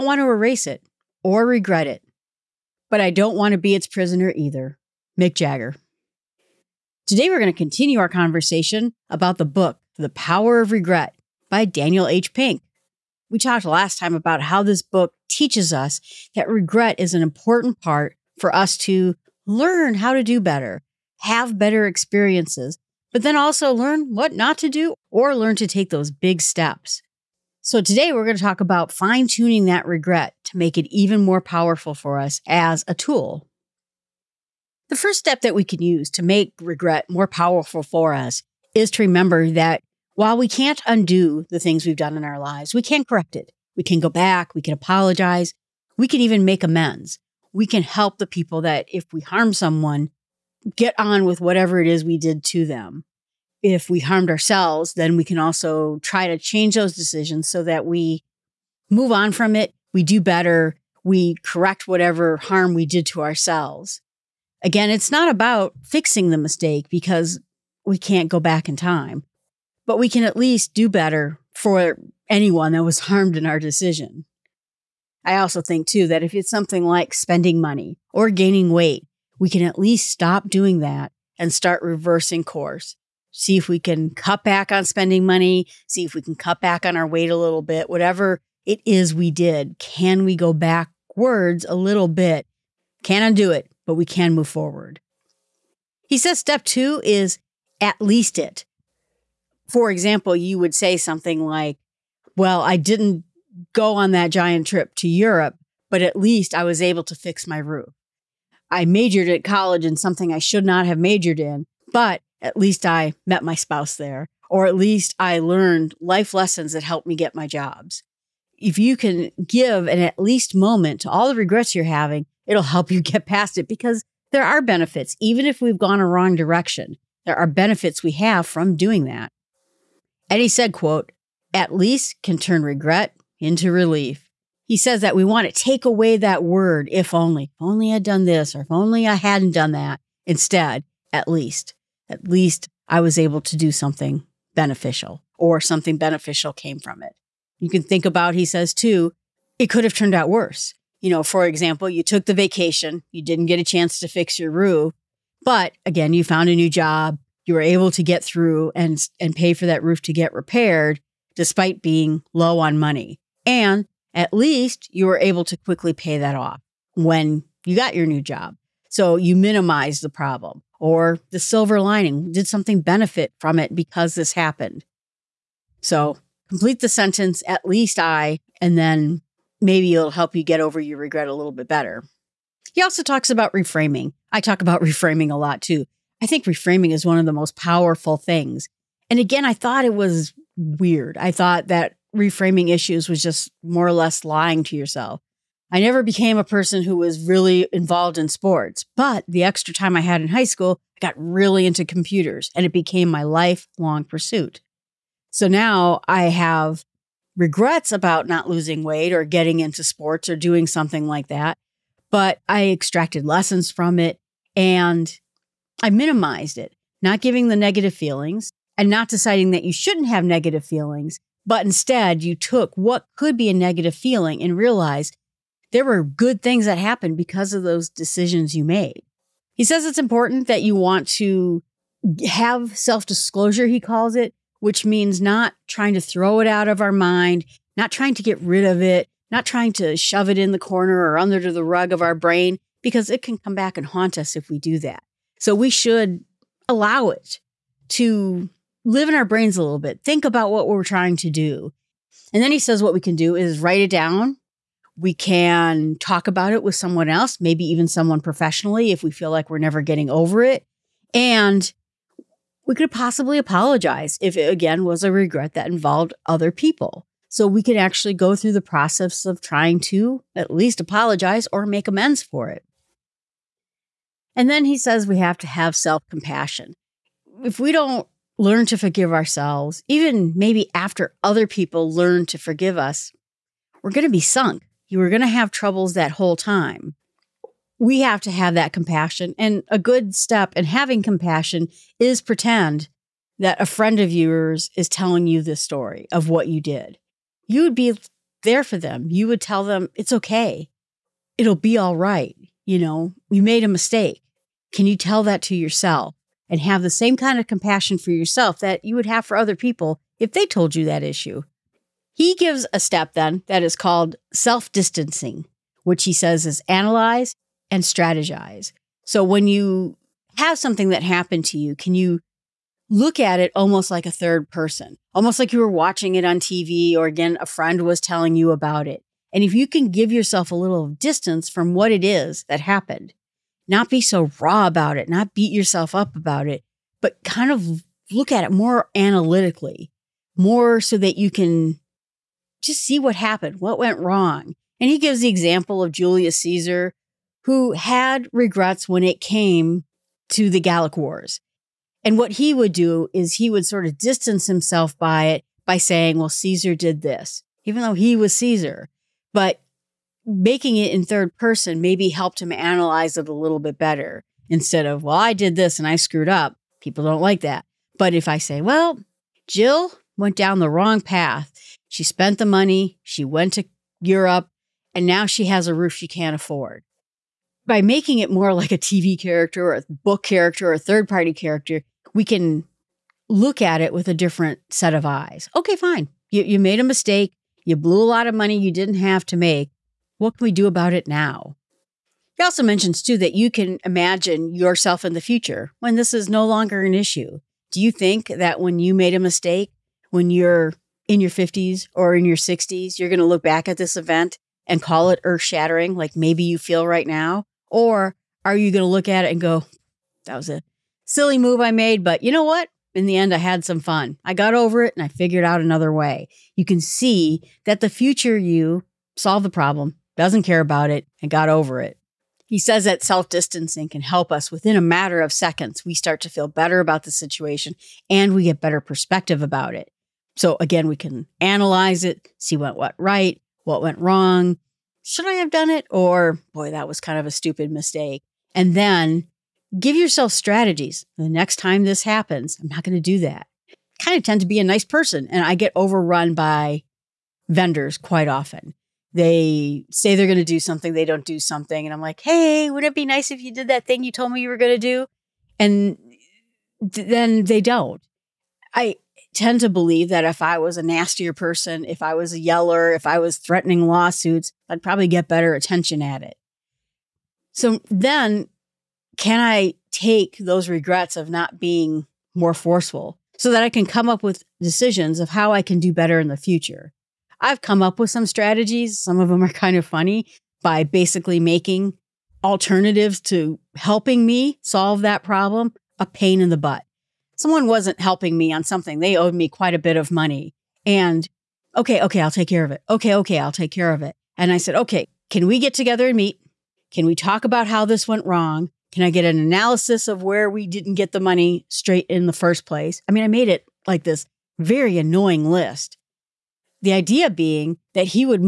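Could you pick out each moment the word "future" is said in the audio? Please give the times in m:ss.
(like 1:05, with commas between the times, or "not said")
6:35, 6:57, 7:56.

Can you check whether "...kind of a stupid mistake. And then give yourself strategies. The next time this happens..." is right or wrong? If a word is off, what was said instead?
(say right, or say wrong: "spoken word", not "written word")
right.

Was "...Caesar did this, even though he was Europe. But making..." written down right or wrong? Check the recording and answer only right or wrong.
wrong.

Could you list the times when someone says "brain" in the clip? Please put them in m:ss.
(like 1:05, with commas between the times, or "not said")
4:02, 4:09.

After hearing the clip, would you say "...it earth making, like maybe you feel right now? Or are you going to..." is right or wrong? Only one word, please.
wrong.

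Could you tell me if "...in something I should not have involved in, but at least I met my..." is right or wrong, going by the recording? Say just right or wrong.
wrong.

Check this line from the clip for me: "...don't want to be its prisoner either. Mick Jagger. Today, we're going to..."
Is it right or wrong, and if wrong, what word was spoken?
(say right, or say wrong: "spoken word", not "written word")
right.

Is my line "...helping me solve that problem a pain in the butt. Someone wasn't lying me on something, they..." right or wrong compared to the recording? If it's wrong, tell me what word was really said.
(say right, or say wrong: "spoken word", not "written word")
wrong: "helping", not "lying".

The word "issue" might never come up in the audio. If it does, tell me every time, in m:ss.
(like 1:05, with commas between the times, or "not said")
3:12, 5:11, 6:36.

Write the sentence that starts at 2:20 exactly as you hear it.
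Instead, at least, at least I was able to do something beneficial or something beneficial came from it.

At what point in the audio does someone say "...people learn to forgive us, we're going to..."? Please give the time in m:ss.
4:41.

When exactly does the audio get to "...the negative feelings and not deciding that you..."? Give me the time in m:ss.
3:37.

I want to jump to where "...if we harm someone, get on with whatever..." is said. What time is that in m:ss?
0:48.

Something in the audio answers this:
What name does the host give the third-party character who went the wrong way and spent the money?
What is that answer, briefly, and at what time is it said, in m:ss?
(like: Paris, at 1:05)
Jill, at 6:09.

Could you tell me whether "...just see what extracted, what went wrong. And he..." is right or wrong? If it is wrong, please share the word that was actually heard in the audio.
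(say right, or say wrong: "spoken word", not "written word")
wrong: "happened", not "extracted".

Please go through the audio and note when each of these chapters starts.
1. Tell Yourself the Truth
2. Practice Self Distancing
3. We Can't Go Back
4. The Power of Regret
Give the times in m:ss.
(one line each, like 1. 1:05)
1. 3:49
2. 5:12
3. 0:34
4. 0:07.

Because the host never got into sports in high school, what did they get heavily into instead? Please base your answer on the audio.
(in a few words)
computers.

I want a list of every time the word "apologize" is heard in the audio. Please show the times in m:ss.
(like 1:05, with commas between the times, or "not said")
0:44, 4:23, 4:30.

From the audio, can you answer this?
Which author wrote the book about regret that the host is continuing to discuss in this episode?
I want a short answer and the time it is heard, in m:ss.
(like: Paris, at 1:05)
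Daniel H. Pink, at 0:11.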